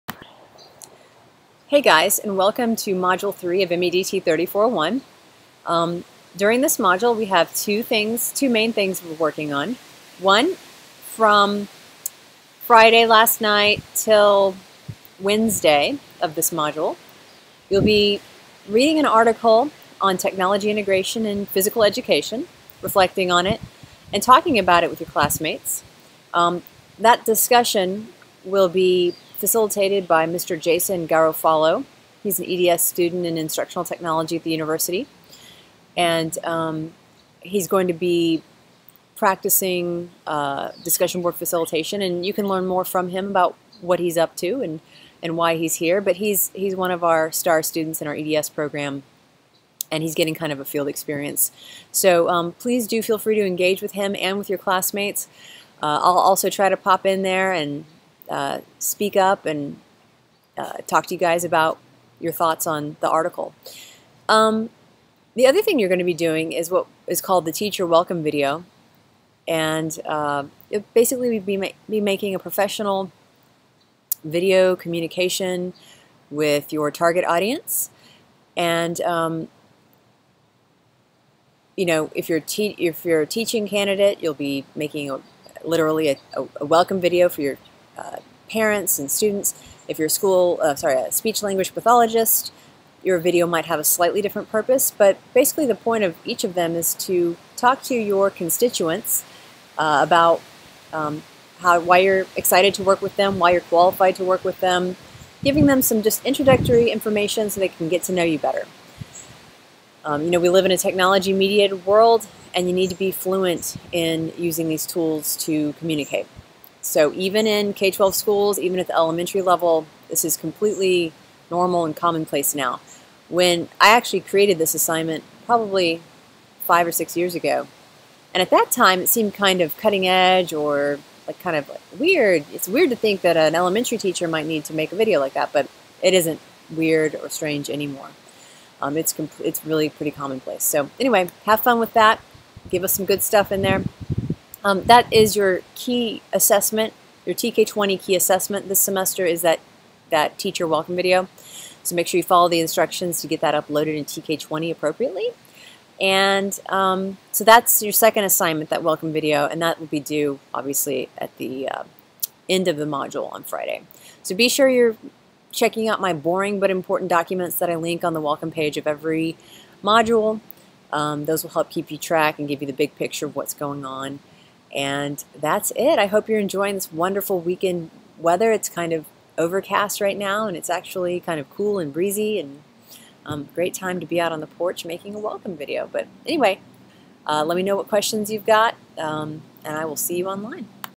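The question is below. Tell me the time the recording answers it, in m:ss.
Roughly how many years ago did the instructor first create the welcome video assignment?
2:06.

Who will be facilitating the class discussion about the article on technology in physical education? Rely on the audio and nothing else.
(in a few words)
Jason Garofalo.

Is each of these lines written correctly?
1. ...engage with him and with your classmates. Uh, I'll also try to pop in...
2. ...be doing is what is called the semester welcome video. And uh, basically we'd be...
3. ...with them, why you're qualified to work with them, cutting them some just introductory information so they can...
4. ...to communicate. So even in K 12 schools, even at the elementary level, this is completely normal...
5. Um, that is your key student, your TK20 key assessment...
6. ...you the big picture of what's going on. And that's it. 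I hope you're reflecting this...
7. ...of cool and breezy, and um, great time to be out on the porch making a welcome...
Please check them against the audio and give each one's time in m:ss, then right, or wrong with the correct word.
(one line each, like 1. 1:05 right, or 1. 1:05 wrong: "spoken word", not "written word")
1. 0:53 right
2. 1:06 wrong: "teacher", not "semester"
3. 1:43 wrong: "giving", not "cutting"
4. 1:55 right
5. 2:24 wrong: "assessment", not "student"
6. 2:52 wrong: "enjoying", not "reflecting"
7. 3:01 right.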